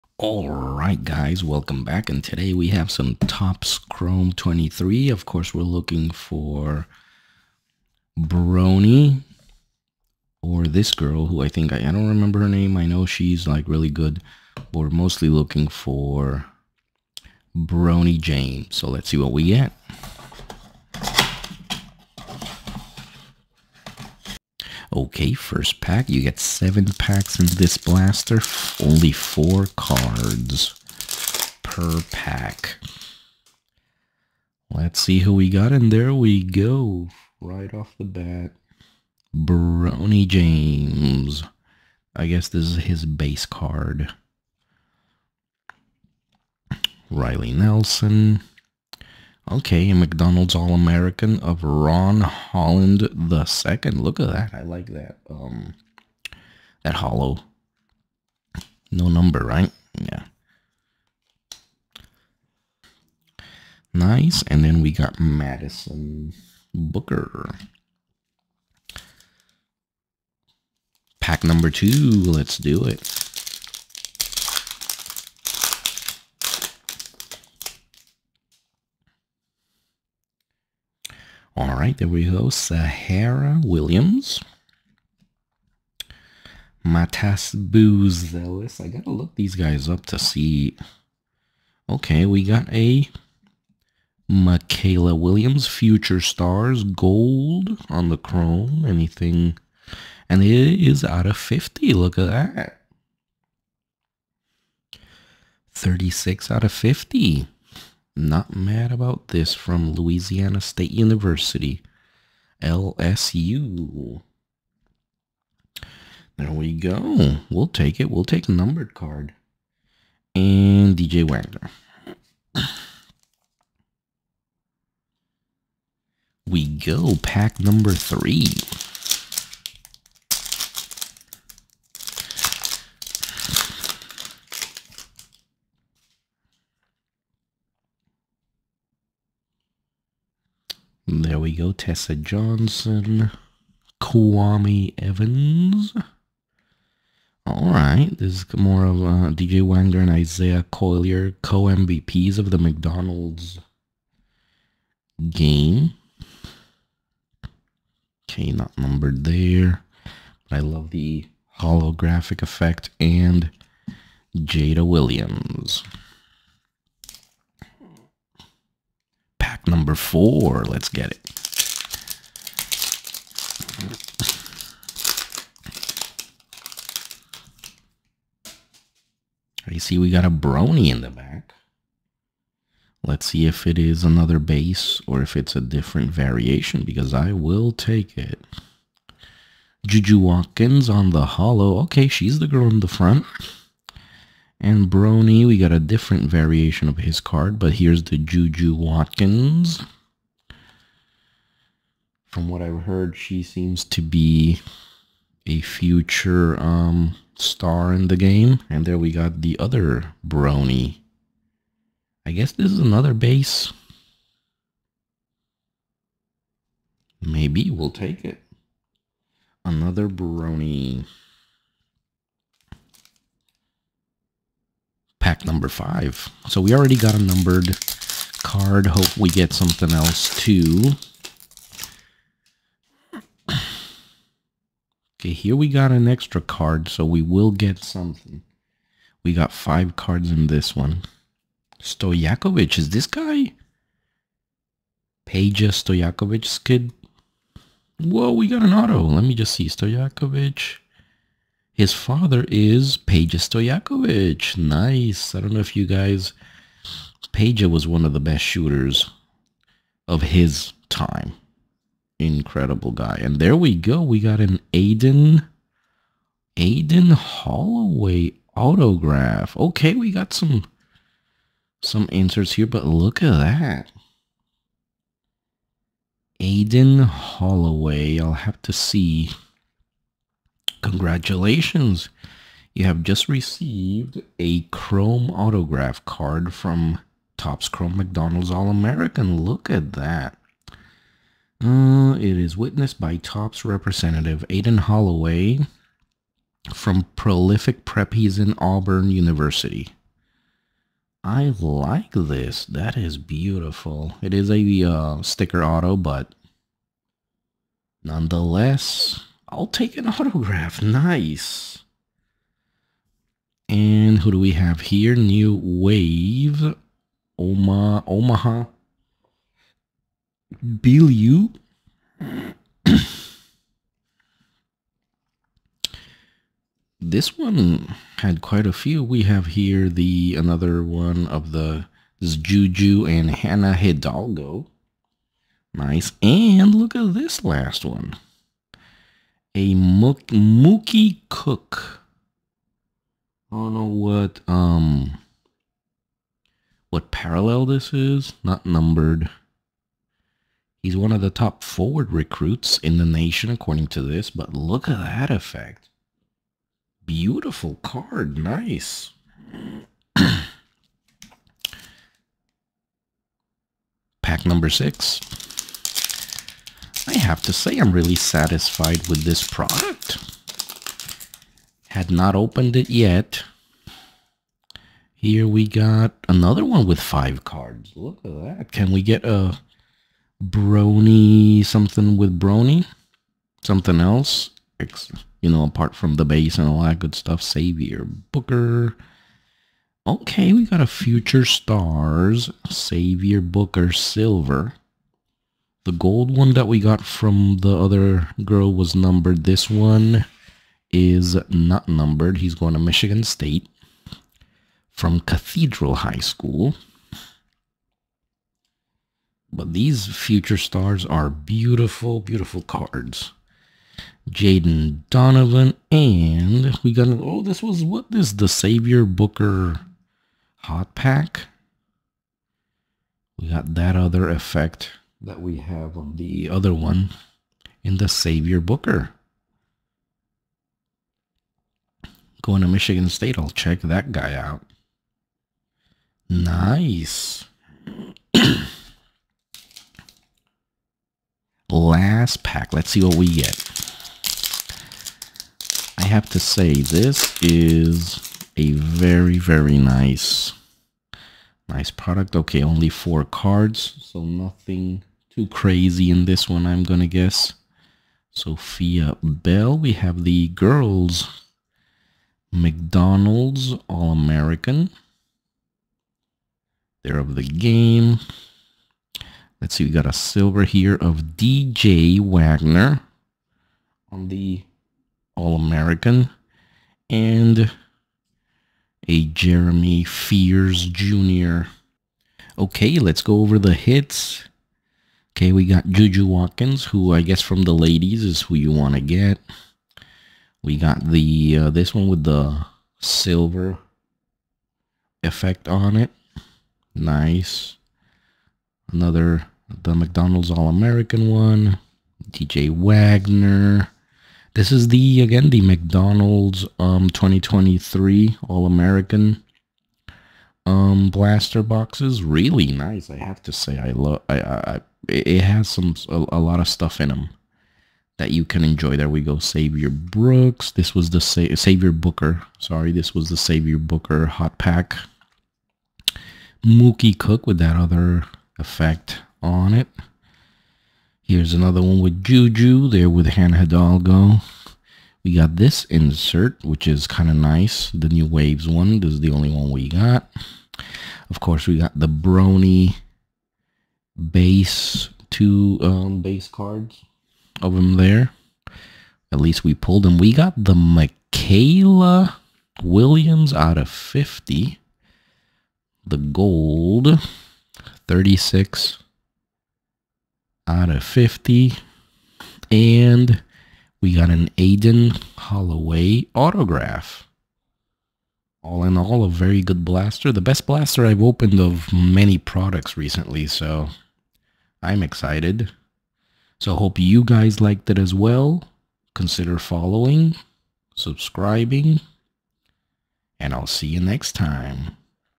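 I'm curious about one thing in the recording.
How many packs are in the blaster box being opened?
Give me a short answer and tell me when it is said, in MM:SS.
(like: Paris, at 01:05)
7, at 00:26.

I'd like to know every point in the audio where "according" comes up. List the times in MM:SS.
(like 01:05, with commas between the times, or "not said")
05:53.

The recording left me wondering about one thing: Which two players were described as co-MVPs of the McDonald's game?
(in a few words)
DJ Wagner and Isaiah Collier.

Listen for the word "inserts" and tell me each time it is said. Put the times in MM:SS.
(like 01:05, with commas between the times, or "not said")
04:32, 08:55.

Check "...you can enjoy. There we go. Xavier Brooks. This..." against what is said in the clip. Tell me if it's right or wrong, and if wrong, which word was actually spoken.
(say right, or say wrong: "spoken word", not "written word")
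right.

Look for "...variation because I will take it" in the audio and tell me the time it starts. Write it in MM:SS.
03:06.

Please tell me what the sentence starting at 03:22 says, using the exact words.
From what I've heard, she seems to be a future um, star in the game.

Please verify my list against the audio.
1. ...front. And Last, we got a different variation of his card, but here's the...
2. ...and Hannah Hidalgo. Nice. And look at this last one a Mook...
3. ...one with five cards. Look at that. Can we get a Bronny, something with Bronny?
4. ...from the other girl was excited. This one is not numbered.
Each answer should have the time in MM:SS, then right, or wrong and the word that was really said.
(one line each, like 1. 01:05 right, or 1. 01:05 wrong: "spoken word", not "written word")
1. 03:12 wrong: "Bronny", not "Last"
2. 05:33 right
3. 06:16 right
4. 06:37 wrong: "numbered", not "excited".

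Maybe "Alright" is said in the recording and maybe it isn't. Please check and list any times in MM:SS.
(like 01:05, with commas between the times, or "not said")
00:00, 02:27.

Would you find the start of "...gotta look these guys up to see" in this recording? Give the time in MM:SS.
01:28.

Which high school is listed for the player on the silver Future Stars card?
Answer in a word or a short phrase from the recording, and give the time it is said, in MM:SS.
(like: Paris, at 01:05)
Cathedral High School, at 06:45.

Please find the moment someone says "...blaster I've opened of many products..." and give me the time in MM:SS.
09:30.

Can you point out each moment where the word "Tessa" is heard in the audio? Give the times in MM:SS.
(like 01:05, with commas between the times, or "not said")
02:21.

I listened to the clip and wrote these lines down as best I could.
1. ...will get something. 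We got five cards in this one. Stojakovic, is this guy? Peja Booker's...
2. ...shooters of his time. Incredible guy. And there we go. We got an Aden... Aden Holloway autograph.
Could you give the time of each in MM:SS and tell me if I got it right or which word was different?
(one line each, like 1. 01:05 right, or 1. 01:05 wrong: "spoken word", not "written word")
1. 03:57 wrong: "Stojakovic", not "Booker"
2. 04:18 right.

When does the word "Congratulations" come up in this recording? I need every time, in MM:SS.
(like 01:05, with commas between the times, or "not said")
04:40.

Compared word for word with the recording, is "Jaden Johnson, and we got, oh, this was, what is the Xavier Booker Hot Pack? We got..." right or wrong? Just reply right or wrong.
wrong.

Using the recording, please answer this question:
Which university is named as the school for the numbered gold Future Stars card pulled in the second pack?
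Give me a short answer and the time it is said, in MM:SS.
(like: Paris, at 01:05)
LSU, at 01:49.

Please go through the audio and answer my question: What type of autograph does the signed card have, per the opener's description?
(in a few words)
sticker auto.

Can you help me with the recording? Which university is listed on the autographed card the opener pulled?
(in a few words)
Auburn University.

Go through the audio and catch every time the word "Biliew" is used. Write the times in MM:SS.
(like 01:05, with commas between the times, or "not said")
05:20.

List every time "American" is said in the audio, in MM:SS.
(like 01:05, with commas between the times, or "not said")
00:50, 04:48, 07:43, 07:55, 08:20, 08:28.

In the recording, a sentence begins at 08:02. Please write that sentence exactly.
Okay, let's go over the hits.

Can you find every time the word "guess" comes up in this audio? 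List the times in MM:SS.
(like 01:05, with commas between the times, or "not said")
00:42, 03:32, 07:37, 08:07.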